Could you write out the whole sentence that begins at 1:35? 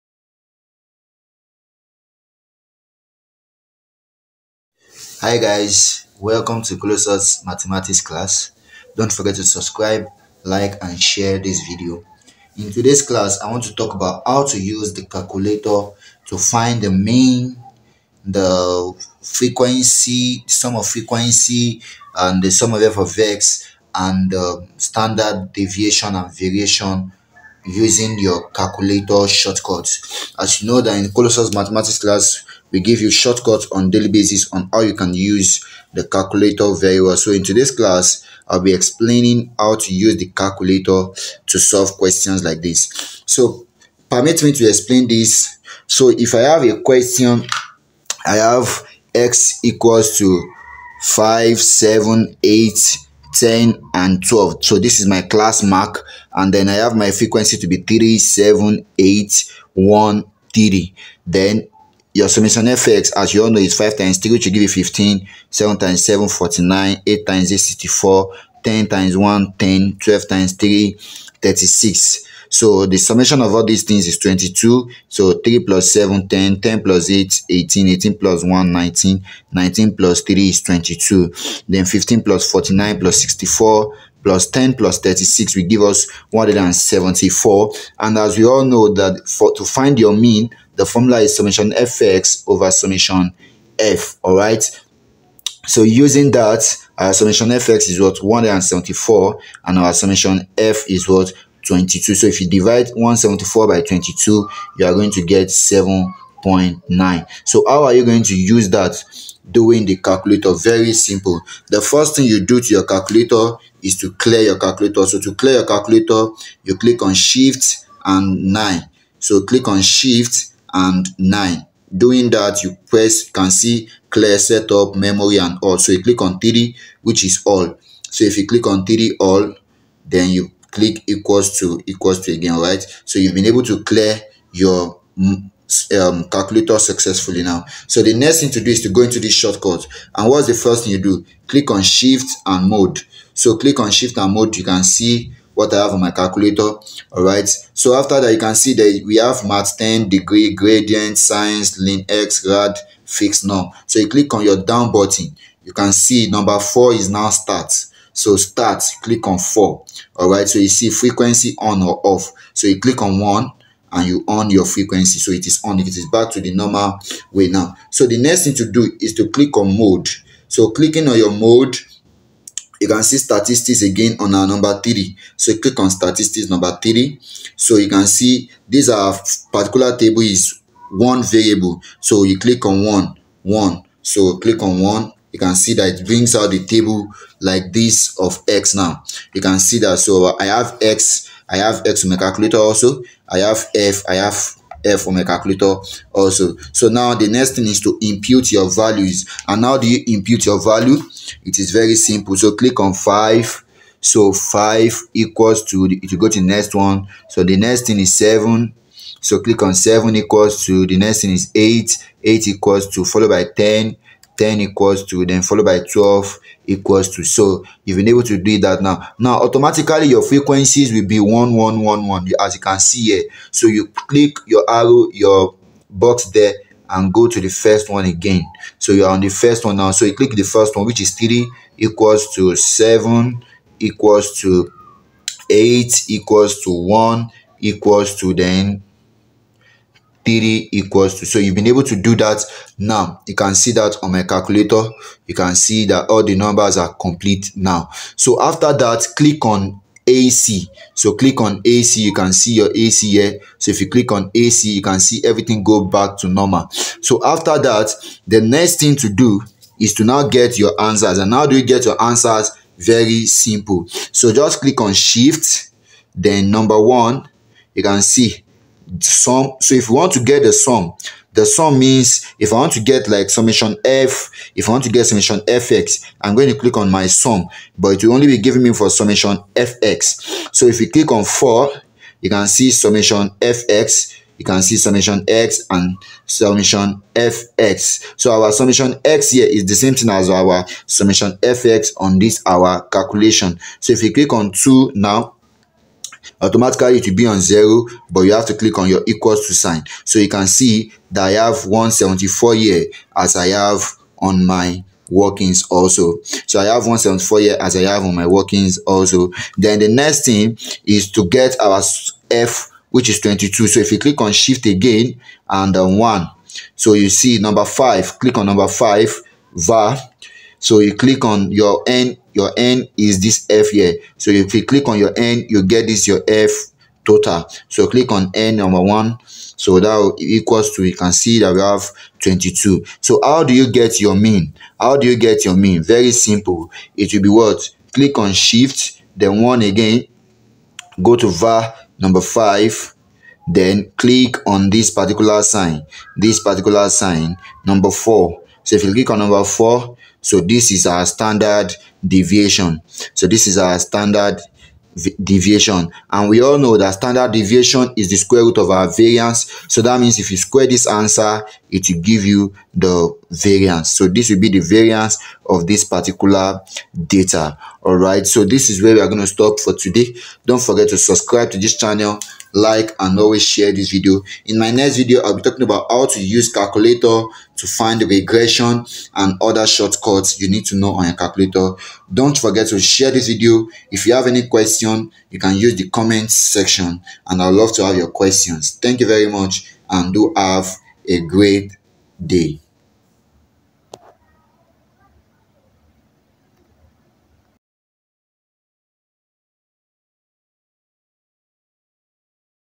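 So using that, our summation fx is what 174 and our summation f is what 22.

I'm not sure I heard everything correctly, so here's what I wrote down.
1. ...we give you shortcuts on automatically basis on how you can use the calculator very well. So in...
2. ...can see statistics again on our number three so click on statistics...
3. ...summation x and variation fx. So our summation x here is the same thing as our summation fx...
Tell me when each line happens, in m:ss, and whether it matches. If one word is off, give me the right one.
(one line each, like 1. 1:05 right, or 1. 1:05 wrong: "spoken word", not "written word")
1. 0:32 wrong: "daily", not "automatically"
2. 2:52 right
3. 4:44 wrong: "summation", not "variation".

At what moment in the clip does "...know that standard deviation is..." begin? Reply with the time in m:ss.
5:56.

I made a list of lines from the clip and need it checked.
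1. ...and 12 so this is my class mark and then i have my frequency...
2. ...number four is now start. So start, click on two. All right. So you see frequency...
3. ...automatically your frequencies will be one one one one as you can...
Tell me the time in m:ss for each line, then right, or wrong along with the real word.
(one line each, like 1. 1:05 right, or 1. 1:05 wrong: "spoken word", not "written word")
1. 0:53 right
2. 2:36 wrong: "four", not "two"
3. 3:39 right.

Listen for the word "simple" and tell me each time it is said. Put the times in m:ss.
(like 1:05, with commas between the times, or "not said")
1:50, 3:21, 4:23, 5:36.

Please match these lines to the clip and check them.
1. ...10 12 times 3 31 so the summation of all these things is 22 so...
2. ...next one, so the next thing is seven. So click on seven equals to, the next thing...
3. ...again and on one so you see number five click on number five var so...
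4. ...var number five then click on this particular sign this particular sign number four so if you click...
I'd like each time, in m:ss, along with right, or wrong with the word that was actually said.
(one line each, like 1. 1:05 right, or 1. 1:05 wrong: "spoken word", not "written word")
1. 1:09 wrong: "36", not "31"
2. 3:26 right
3. 5:14 right
4. 5:41 right.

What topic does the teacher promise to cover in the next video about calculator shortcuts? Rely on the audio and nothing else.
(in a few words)
Regression.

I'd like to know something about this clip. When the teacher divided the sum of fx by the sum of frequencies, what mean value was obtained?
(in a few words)
7.9.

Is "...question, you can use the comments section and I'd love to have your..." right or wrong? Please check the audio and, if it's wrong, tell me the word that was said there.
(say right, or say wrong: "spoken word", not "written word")
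right.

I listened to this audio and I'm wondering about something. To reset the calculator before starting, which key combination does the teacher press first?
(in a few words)
Shift and 9.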